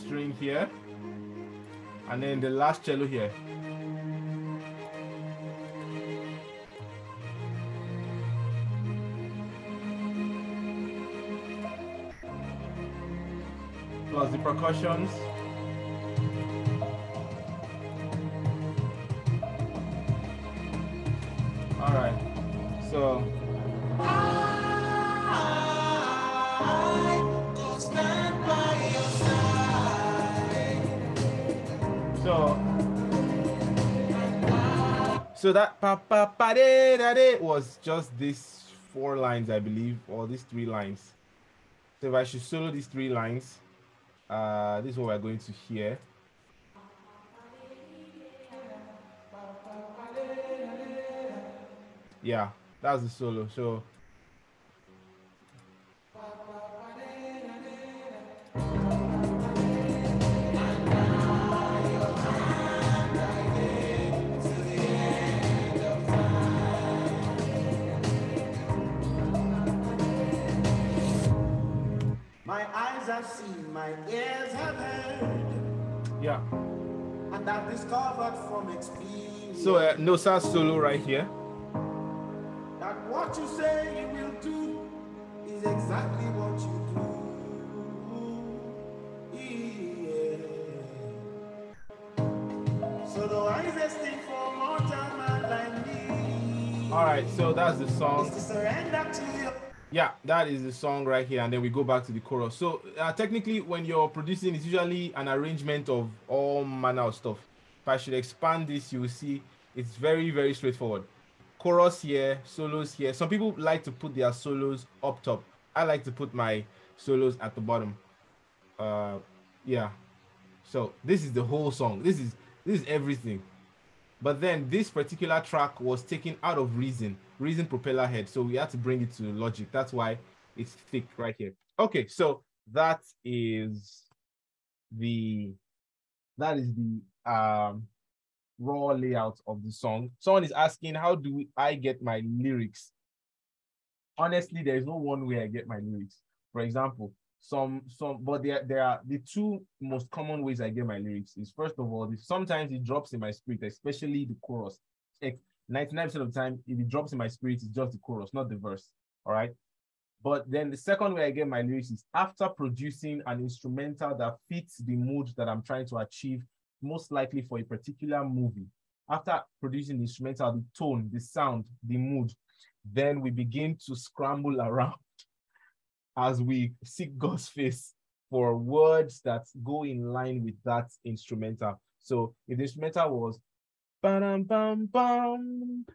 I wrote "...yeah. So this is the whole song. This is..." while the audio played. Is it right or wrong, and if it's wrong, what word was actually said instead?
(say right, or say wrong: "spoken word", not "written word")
right.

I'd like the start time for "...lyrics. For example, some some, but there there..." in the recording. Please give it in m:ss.
2:25.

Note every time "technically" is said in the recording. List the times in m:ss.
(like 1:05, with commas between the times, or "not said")
1:43.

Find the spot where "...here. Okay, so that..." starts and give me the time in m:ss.
2:11.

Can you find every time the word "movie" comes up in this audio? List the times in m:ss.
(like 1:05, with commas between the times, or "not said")
2:48.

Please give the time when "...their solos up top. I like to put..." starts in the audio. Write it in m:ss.
1:54.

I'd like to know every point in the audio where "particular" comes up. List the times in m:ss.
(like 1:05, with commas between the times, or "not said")
2:04, 2:47.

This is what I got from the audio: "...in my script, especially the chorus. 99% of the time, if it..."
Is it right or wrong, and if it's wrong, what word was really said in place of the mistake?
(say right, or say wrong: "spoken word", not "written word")
right.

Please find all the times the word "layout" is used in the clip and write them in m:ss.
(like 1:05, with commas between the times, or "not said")
2:18.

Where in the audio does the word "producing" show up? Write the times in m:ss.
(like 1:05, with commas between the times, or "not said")
1:44, 2:42, 2:49.